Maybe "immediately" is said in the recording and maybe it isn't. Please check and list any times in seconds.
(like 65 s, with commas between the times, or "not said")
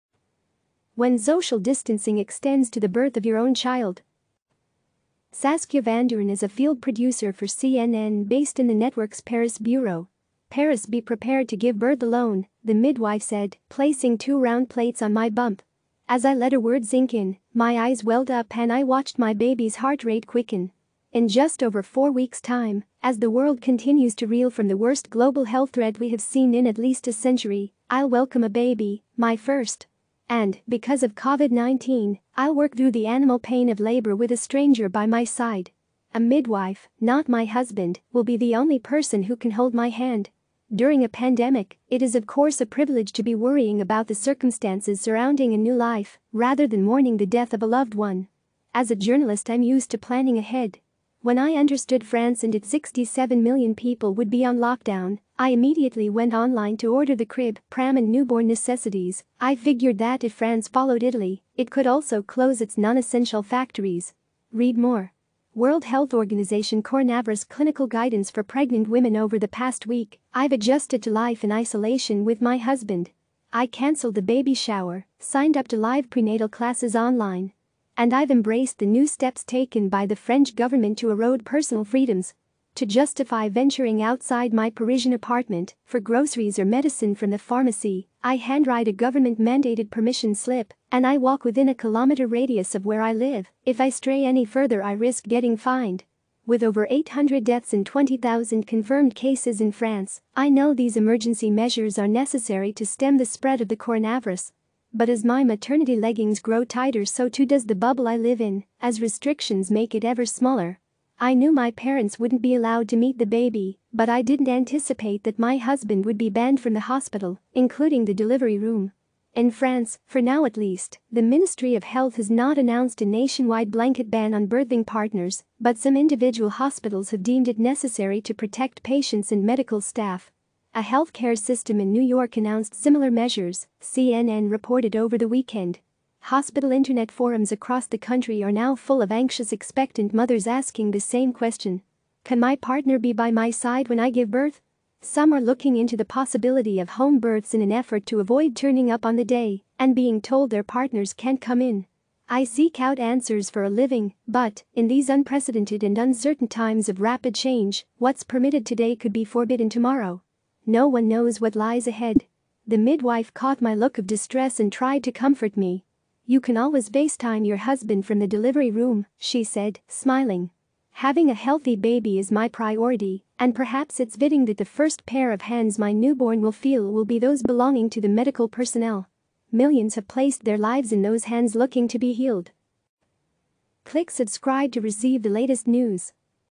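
55 s.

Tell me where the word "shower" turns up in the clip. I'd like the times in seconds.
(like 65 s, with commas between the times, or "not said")
74 s.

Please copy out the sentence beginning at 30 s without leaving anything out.
And, because of COVID-19, I'll work through the animal pain of labor with a stranger by my side.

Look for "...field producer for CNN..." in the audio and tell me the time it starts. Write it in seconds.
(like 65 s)
6 s.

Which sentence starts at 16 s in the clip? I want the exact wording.
As I let a word sink in, my eyes welled up and I watched my baby's heart rate quicken.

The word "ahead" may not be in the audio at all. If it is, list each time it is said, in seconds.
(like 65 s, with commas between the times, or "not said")
50 s, 161 s.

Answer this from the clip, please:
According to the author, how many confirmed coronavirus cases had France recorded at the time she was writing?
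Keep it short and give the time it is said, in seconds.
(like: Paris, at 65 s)
20,000, at 97 s.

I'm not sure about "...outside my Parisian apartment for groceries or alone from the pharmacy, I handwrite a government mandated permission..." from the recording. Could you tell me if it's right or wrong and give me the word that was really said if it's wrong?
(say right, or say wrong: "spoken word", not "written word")
wrong: "medicine", not "alone".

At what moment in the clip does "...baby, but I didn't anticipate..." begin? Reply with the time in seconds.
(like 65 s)
113 s.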